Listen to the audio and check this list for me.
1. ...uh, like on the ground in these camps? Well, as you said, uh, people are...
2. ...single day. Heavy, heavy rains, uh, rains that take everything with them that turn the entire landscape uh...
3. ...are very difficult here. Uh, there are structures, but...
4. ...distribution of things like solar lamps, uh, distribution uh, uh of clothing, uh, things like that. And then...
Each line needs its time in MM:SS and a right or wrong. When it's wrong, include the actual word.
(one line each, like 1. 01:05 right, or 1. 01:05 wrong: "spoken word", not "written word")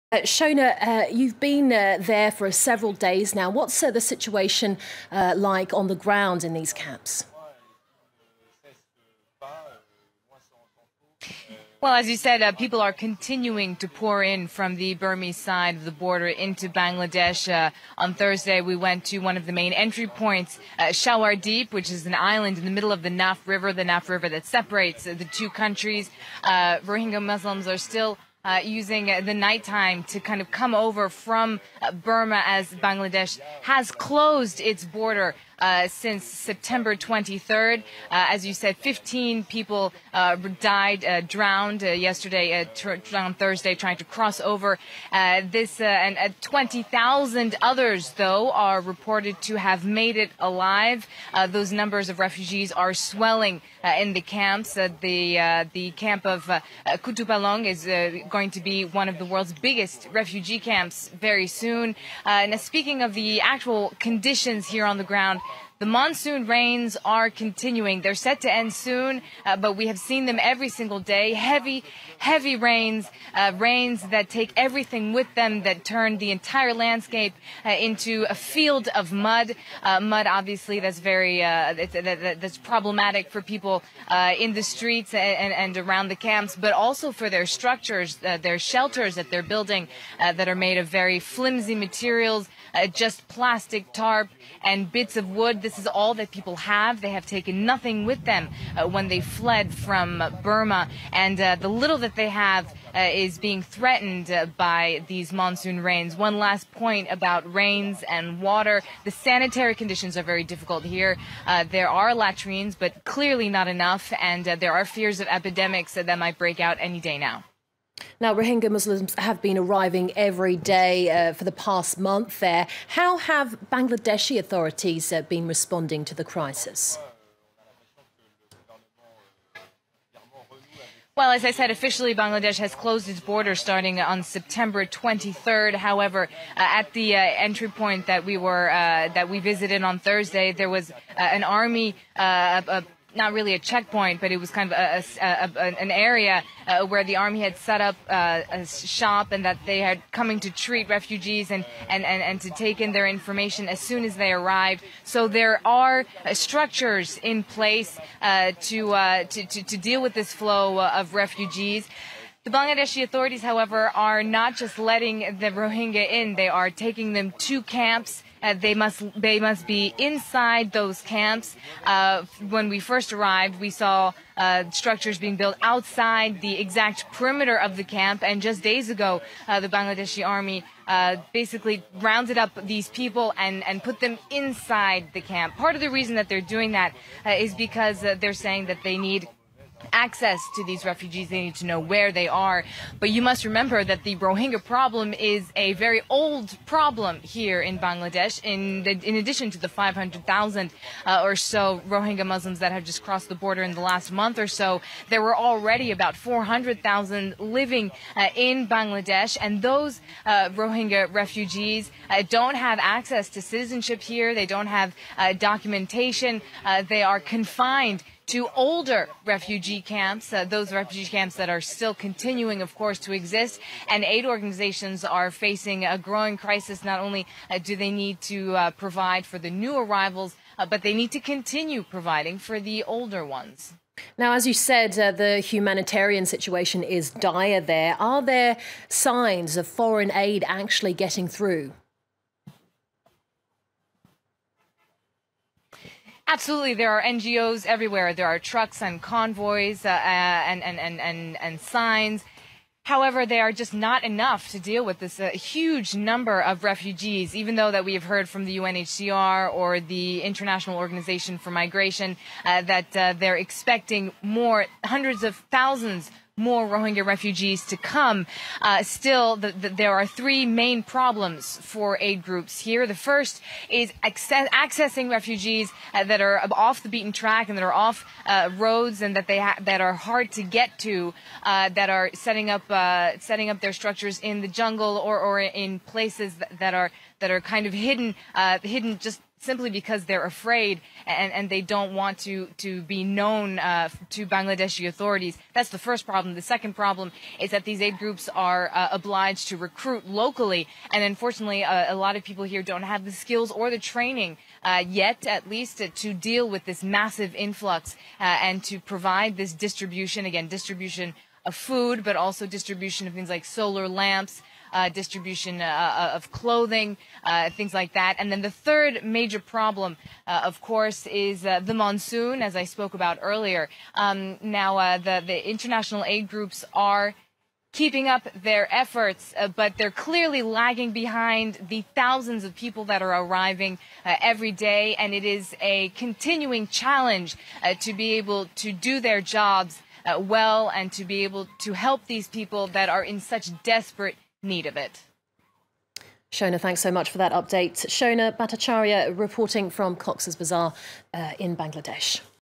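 1. 00:05 right
2. 01:10 right
3. 01:50 wrong: "latrines", not "structures"
4. 05:12 right.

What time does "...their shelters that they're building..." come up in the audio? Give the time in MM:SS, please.
01:28.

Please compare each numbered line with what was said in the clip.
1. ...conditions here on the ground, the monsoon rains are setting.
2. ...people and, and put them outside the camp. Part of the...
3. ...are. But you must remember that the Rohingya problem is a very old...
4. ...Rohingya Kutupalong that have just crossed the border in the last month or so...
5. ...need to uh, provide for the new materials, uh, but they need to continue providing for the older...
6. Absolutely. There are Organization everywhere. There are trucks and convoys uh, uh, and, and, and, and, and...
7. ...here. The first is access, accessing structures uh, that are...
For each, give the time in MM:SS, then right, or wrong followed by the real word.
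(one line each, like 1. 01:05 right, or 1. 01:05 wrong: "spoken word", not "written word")
1. 01:03 wrong: "continuing", not "setting"
2. 03:02 wrong: "inside", not "outside"
3. 03:12 right
4. 03:21 wrong: "Muslims", not "Kutupalong"
5. 03:47 wrong: "arrivals", not "materials"
6. 04:06 wrong: "NGOs", not "Organization"
7. 04:32 wrong: "refugees", not "structures".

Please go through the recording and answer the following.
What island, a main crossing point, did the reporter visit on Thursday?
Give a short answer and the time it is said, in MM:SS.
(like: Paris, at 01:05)
Deep, at 00:21.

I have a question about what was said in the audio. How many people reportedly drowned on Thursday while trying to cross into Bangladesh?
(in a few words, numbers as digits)
15.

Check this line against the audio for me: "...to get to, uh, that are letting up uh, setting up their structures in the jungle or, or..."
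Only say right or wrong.
wrong.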